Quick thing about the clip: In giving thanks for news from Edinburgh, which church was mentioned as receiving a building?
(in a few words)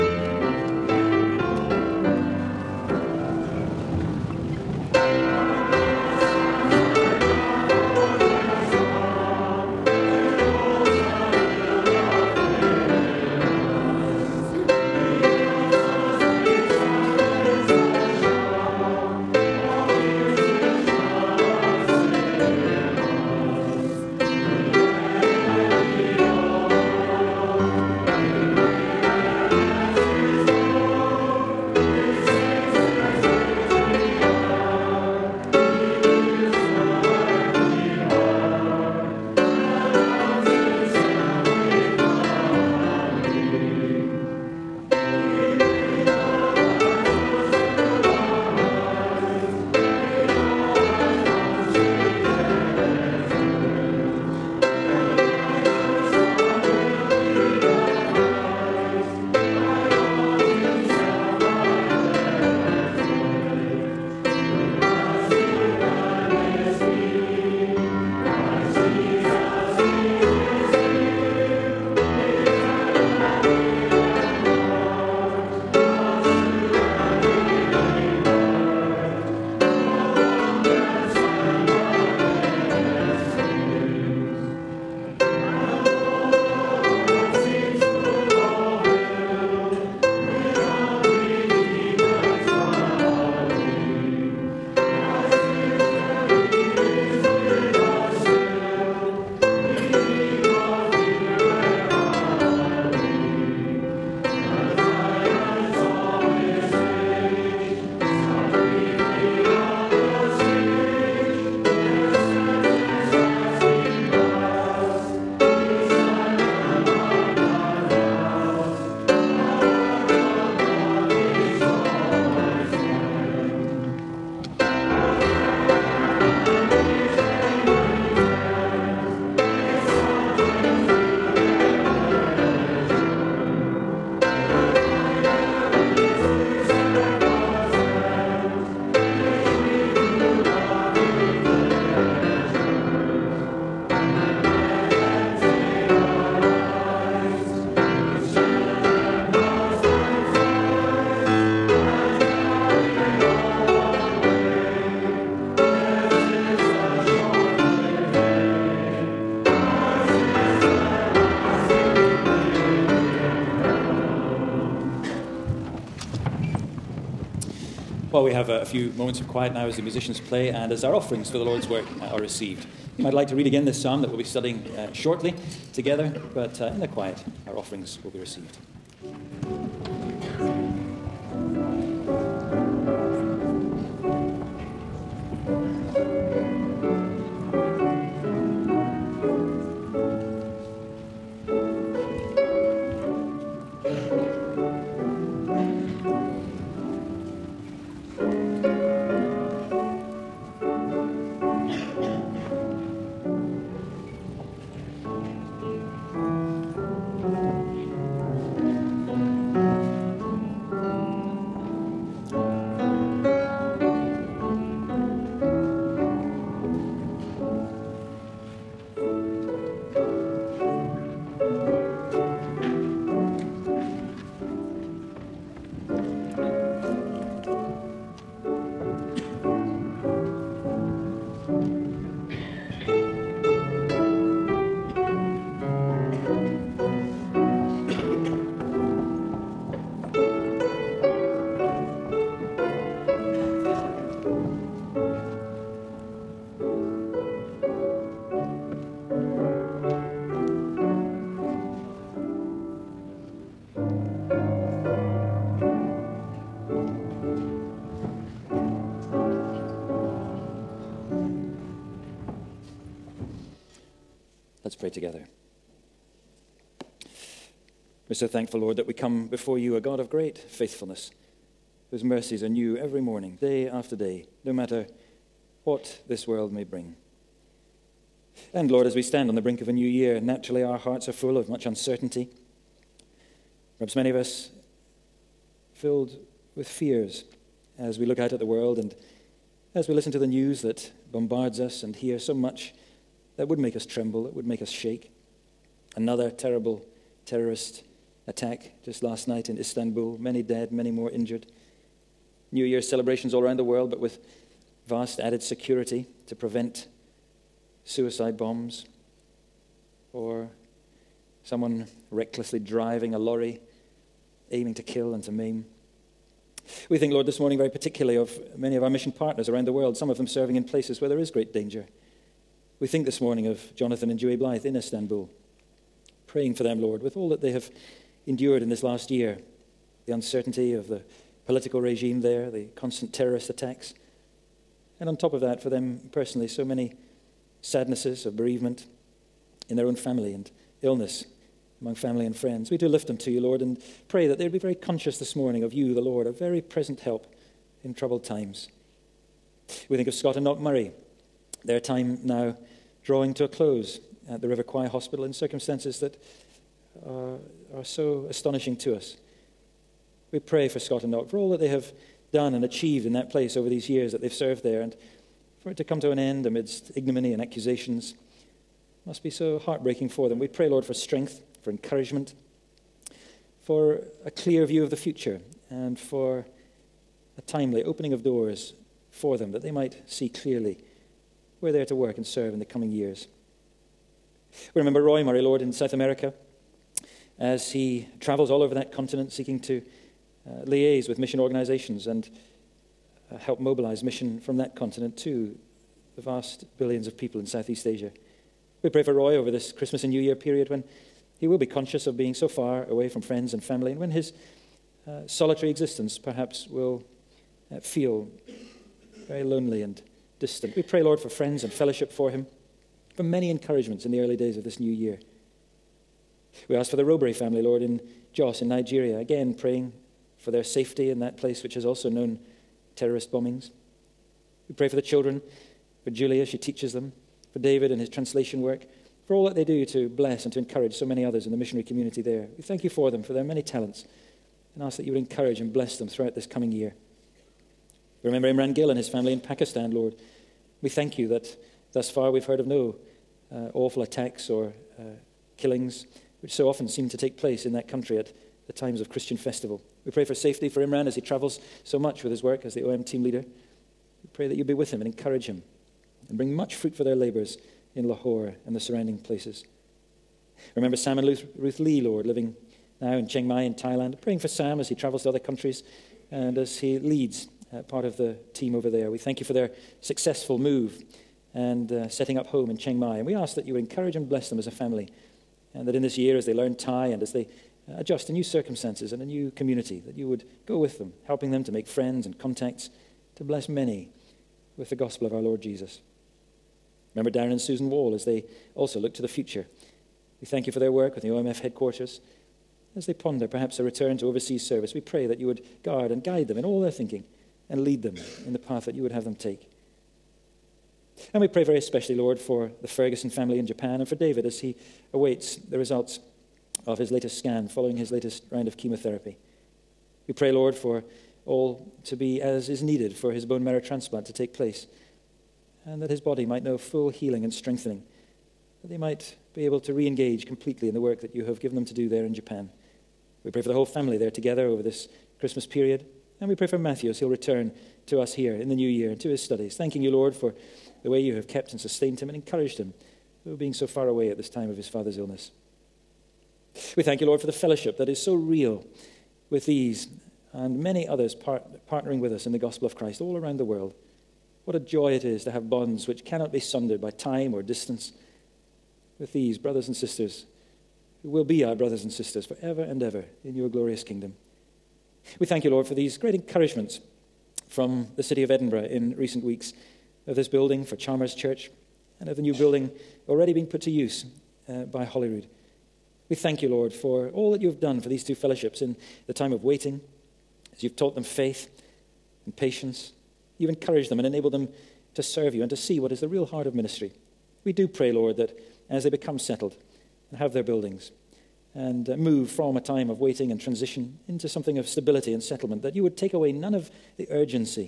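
Chalmers Church.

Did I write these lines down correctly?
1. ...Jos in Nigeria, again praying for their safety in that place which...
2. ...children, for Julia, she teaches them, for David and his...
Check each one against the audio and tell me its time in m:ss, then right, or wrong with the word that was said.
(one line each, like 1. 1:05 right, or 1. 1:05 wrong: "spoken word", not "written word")
1. 6:58 right
2. 7:05 right.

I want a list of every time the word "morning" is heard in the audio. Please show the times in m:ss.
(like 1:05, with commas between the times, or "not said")
4:33, 5:17, 5:23, 5:45.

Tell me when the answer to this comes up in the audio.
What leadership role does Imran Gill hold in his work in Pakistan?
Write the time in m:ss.
7:32.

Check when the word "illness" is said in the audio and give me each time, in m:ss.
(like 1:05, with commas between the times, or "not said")
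5:40, 8:55.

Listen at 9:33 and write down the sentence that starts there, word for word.
You've encouraged them and enabled them to serve you and to see what is the real heart of ministry.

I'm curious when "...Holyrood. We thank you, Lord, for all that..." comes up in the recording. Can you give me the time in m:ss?
9:25.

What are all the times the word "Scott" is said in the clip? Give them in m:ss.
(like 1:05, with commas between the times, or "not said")
5:50, 6:00.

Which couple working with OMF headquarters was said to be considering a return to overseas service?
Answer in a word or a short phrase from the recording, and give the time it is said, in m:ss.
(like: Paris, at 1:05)
Darren and Susan Wall, at 8:07.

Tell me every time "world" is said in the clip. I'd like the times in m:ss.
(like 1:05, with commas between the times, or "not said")
4:36, 4:48, 5:03, 5:19, 9:03.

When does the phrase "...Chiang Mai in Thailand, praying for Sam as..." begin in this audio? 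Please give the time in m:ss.
7:43.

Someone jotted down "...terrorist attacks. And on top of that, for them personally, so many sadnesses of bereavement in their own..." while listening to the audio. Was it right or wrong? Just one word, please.
right.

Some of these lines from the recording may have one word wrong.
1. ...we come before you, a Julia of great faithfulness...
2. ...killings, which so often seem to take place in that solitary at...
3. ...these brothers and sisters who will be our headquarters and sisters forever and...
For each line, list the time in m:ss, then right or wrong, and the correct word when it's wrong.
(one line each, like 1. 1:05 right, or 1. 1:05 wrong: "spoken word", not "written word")
1. 4:28 wrong: "God", not "Julia"
2. 7:25 wrong: "country", not "solitary"
3. 9:09 wrong: "brothers", not "headquarters".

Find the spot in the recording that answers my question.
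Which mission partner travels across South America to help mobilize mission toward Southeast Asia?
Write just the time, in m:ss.
6:25.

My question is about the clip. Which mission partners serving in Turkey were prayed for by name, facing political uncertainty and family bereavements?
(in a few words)
Jonathan and Dewey Blythe.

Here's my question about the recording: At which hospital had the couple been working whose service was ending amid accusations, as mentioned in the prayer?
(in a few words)
River Choir Hospital.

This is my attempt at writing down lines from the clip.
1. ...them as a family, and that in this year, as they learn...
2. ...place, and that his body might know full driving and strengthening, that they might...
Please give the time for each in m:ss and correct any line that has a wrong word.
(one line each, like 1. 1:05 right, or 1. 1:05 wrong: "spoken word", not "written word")
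1. 7:54 right
2. 8:34 wrong: "healing", not "driving".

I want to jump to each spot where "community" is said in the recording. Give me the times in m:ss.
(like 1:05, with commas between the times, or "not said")
7:11, 7:59.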